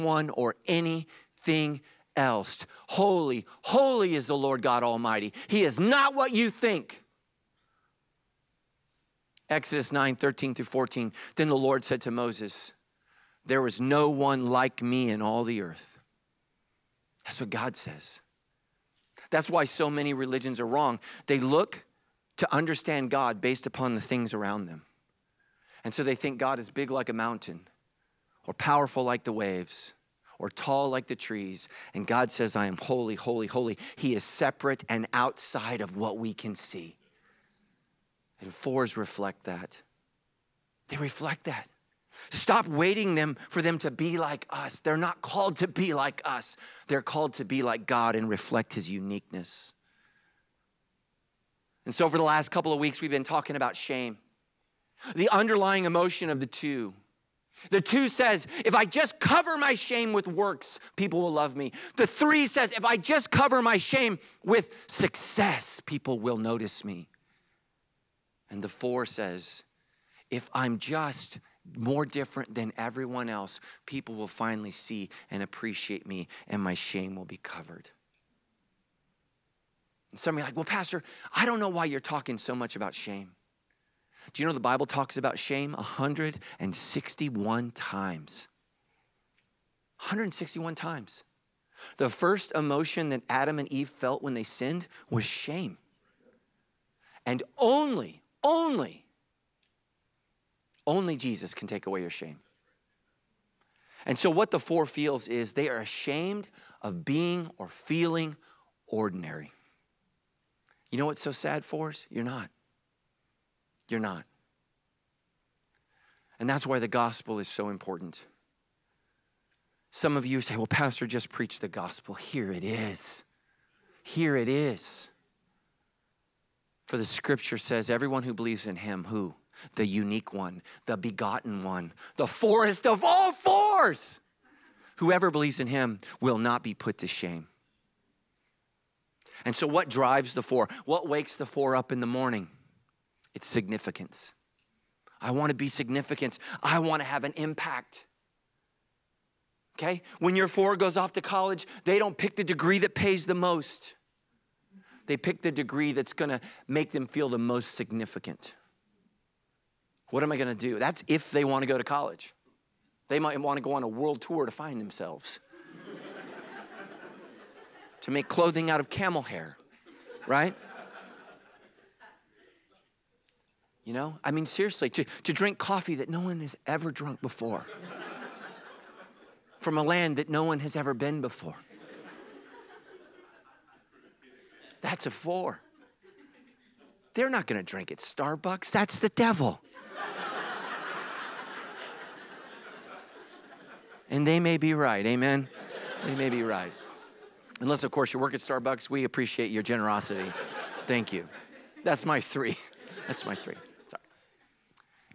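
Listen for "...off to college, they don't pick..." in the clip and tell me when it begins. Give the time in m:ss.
2:30.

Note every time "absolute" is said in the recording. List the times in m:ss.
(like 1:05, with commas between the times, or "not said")
not said.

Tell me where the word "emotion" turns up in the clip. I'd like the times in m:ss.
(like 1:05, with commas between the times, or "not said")
0:55, 1:32.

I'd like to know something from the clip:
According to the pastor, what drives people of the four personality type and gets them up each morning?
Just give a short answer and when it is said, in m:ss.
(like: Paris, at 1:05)
Significance, at 2:23.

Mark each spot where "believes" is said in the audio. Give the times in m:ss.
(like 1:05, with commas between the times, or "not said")
2:08, 2:15.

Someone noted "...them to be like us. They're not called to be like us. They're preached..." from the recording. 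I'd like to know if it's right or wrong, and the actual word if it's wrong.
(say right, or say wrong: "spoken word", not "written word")
wrong: "called", not "preached".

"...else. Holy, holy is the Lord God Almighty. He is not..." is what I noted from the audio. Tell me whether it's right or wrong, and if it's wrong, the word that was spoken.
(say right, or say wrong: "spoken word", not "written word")
right.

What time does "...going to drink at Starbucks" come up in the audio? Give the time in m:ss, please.
3:07.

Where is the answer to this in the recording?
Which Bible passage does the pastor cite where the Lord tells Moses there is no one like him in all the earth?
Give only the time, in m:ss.
0:09.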